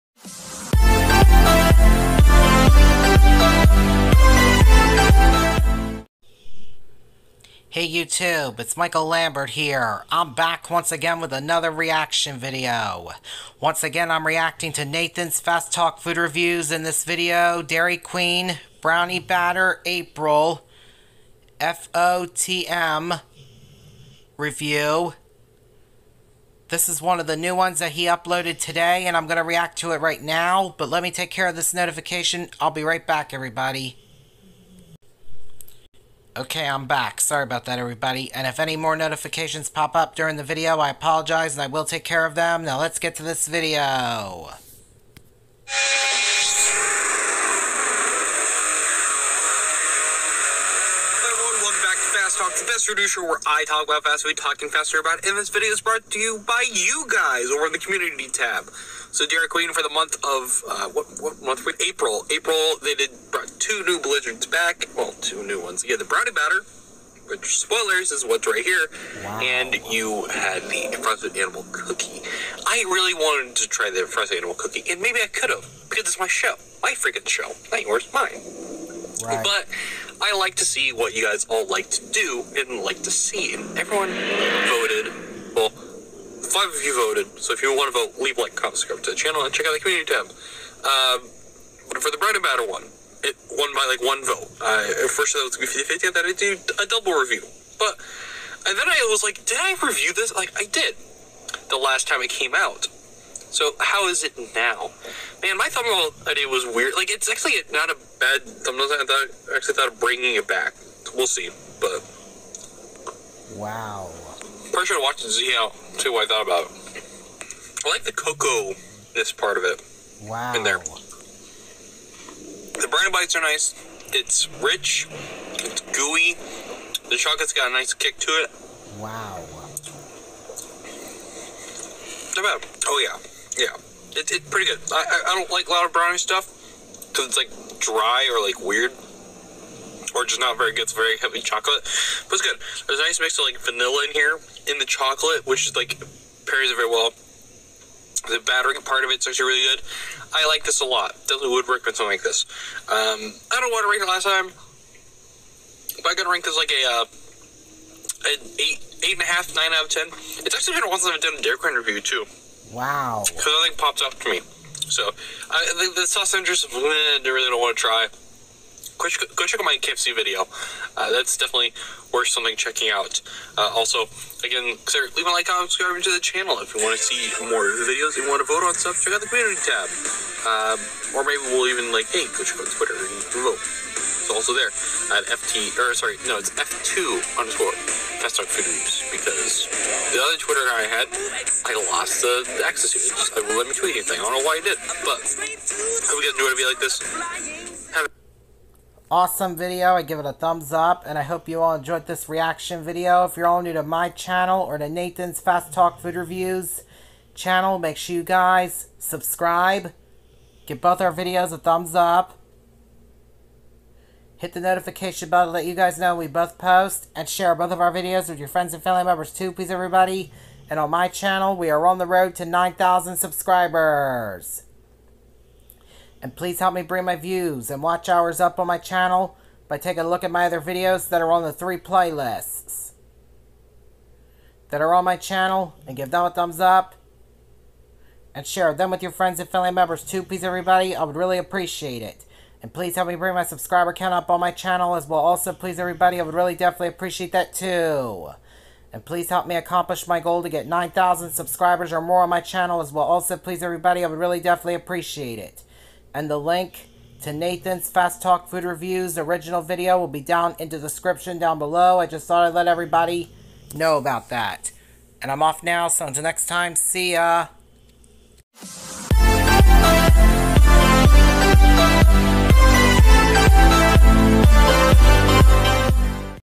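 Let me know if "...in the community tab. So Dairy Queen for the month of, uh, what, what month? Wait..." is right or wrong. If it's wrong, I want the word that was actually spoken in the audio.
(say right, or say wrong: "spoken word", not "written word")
right.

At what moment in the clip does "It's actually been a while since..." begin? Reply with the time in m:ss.
2:40.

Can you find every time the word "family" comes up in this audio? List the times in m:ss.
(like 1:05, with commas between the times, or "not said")
3:38, 3:59.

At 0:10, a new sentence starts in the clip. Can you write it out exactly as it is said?
I'm back once again with another reaction video.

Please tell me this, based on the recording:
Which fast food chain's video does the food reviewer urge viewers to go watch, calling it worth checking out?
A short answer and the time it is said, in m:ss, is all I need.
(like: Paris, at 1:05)
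KFC, at 2:49.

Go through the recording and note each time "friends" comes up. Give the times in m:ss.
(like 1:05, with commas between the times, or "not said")
3:38, 3:59.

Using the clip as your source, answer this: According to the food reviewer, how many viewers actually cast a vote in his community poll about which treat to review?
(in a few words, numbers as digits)
5.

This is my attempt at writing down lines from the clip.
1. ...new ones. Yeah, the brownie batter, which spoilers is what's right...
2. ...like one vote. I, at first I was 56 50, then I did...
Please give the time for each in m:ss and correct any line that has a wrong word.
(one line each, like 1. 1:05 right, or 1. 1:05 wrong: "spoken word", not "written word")
1. 1:05 right
2. 1:33 wrong: "50", not "56".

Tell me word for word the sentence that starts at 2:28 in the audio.
The battering part of it's actually really good.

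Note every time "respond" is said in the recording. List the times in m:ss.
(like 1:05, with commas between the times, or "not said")
not said.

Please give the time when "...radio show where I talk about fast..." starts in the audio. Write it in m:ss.
0:52.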